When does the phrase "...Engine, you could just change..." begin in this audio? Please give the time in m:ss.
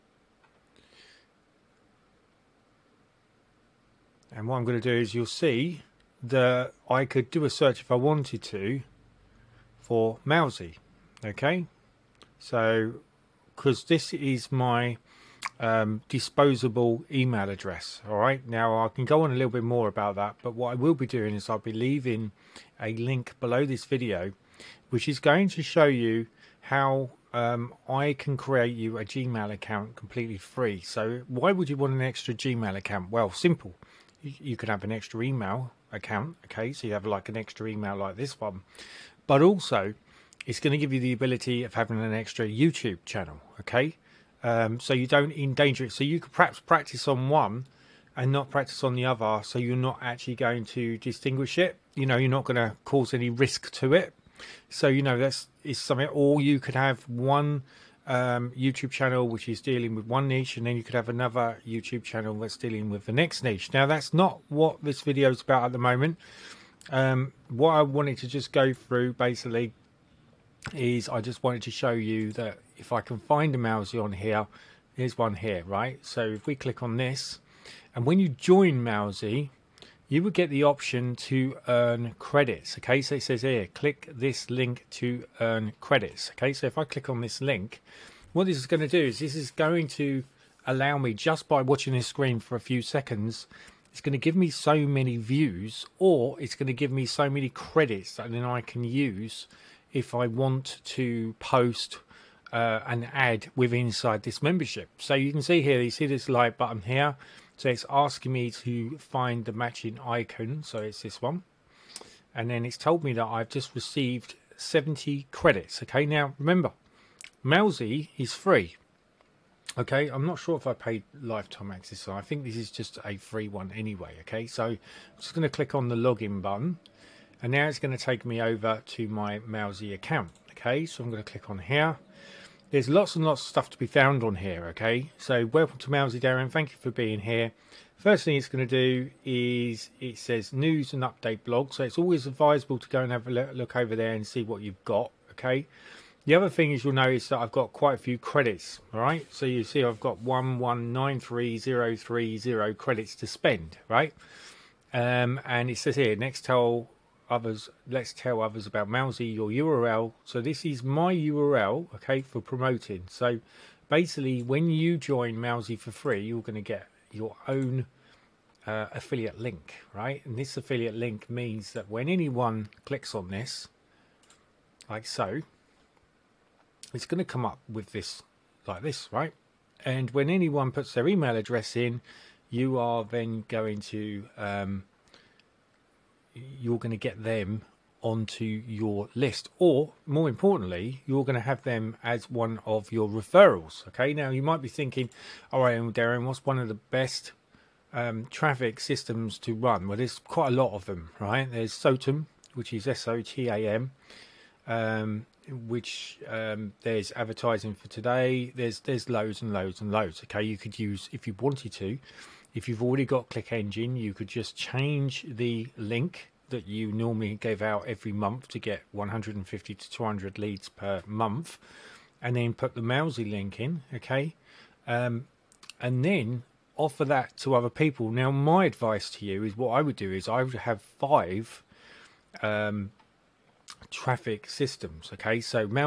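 3:33.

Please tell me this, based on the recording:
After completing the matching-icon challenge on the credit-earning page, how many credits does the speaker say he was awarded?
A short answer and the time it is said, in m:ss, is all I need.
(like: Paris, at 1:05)
70, at 1:54.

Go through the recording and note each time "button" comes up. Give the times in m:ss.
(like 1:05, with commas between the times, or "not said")
1:46, 2:06.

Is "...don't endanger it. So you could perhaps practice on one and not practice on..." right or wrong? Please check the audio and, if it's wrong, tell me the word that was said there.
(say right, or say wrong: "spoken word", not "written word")
right.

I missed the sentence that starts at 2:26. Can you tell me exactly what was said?
The other thing is you'll notice that I've got quite a few credits, all right?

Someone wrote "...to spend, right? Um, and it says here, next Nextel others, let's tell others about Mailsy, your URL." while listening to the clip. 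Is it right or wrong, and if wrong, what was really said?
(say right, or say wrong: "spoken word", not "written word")
right.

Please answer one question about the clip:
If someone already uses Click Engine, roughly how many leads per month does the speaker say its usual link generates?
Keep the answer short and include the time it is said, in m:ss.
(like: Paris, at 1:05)
150 to 200, at 3:38.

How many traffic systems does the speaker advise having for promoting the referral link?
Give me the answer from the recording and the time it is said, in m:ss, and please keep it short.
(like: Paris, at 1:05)
5, at 3:50.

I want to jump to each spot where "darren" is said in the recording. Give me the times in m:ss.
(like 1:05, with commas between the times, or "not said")
2:16, 3:15.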